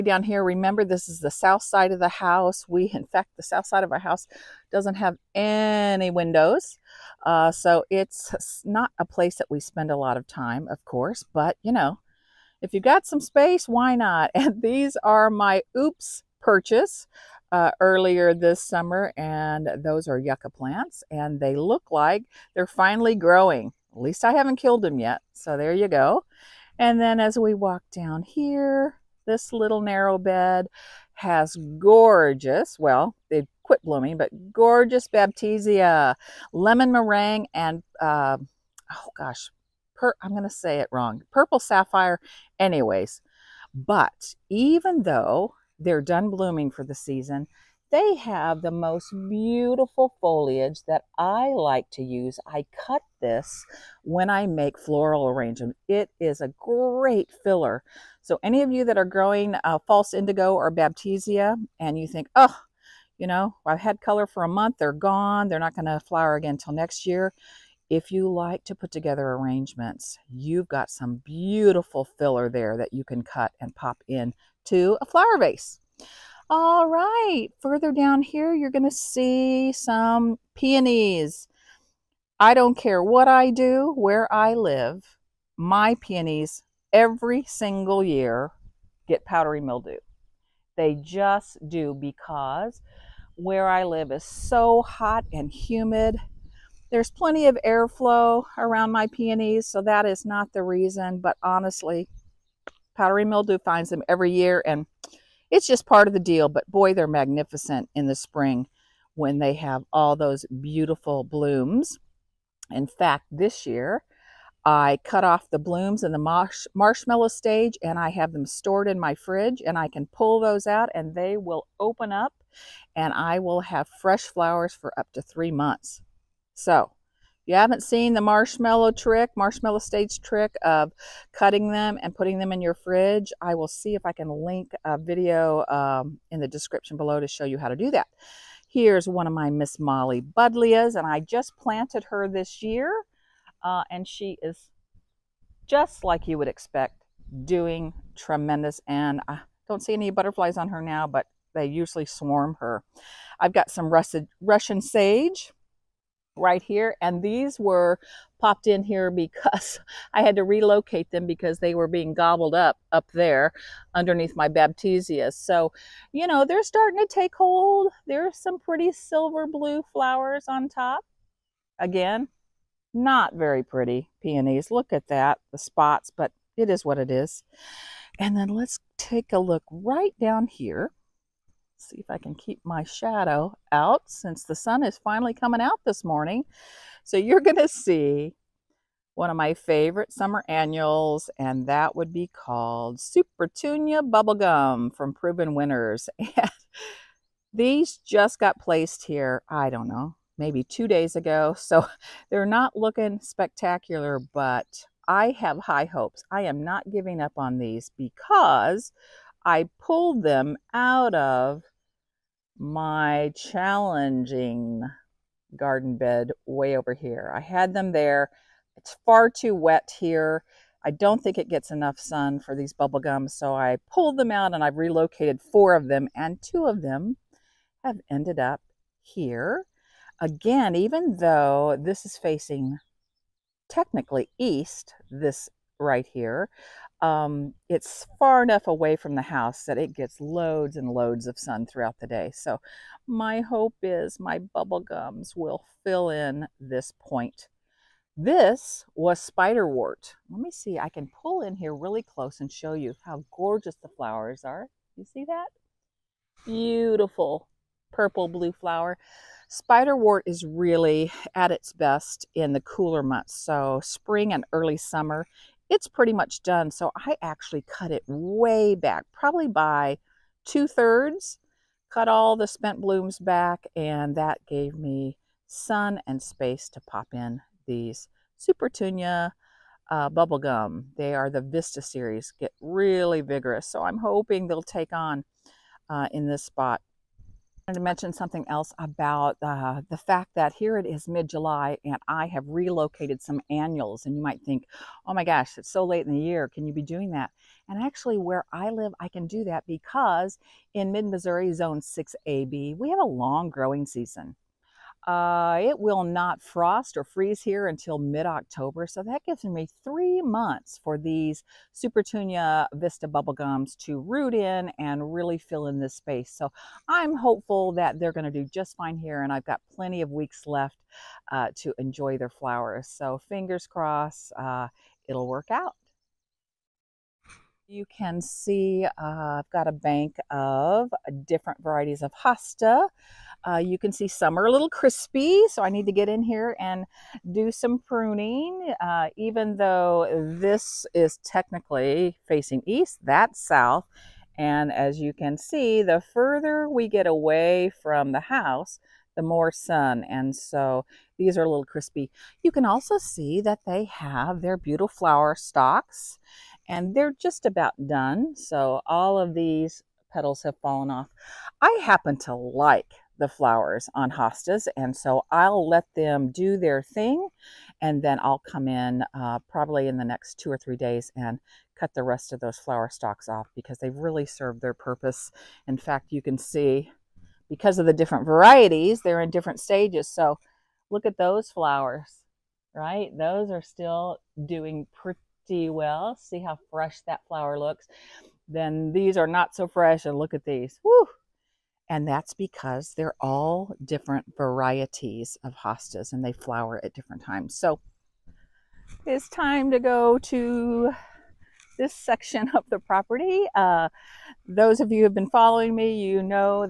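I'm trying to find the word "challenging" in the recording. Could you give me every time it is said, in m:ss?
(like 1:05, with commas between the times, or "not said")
3:33.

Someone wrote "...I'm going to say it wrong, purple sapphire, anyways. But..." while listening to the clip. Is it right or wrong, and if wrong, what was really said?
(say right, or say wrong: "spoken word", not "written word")
right.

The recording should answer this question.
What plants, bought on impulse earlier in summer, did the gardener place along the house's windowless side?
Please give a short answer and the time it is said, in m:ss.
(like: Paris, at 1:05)
yucca plants, at 0:20.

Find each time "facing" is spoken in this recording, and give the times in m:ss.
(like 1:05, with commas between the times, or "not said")
3:52, 5:42.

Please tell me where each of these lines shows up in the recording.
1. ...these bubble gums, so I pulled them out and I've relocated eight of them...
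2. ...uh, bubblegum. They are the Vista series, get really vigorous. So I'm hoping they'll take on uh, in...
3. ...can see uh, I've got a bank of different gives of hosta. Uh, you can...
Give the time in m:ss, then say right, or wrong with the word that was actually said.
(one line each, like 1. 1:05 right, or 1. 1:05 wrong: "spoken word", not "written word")
1. 3:42 wrong: "four", not "eight"
2. 4:39 right
3. 5:27 wrong: "varieties", not "gives".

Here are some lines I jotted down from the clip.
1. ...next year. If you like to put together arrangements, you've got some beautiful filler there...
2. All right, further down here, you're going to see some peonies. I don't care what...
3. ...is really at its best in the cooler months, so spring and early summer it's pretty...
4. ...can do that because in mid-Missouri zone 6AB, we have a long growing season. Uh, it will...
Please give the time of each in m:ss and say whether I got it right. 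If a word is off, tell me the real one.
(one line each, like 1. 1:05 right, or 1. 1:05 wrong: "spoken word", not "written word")
1. 1:06 right
2. 1:16 right
3. 4:20 right
4. 4:59 right.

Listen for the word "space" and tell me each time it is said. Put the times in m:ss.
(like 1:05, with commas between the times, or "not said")
0:13, 4:36, 5:15.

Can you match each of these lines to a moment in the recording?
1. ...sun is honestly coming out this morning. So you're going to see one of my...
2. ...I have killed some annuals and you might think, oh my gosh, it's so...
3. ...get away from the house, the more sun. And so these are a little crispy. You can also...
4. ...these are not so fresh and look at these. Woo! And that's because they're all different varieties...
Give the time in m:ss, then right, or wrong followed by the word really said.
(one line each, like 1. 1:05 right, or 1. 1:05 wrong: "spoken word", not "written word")
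1. 3:04 wrong: "finally", not "honestly"
2. 4:52 wrong: "relocated", not "killed"
3. 5:46 right
4. 6:28 right.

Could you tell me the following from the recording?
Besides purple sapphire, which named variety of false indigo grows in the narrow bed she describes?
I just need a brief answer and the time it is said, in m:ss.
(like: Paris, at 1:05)
lemon meringue, at 0:36.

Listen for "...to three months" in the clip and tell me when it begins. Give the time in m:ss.
2:05.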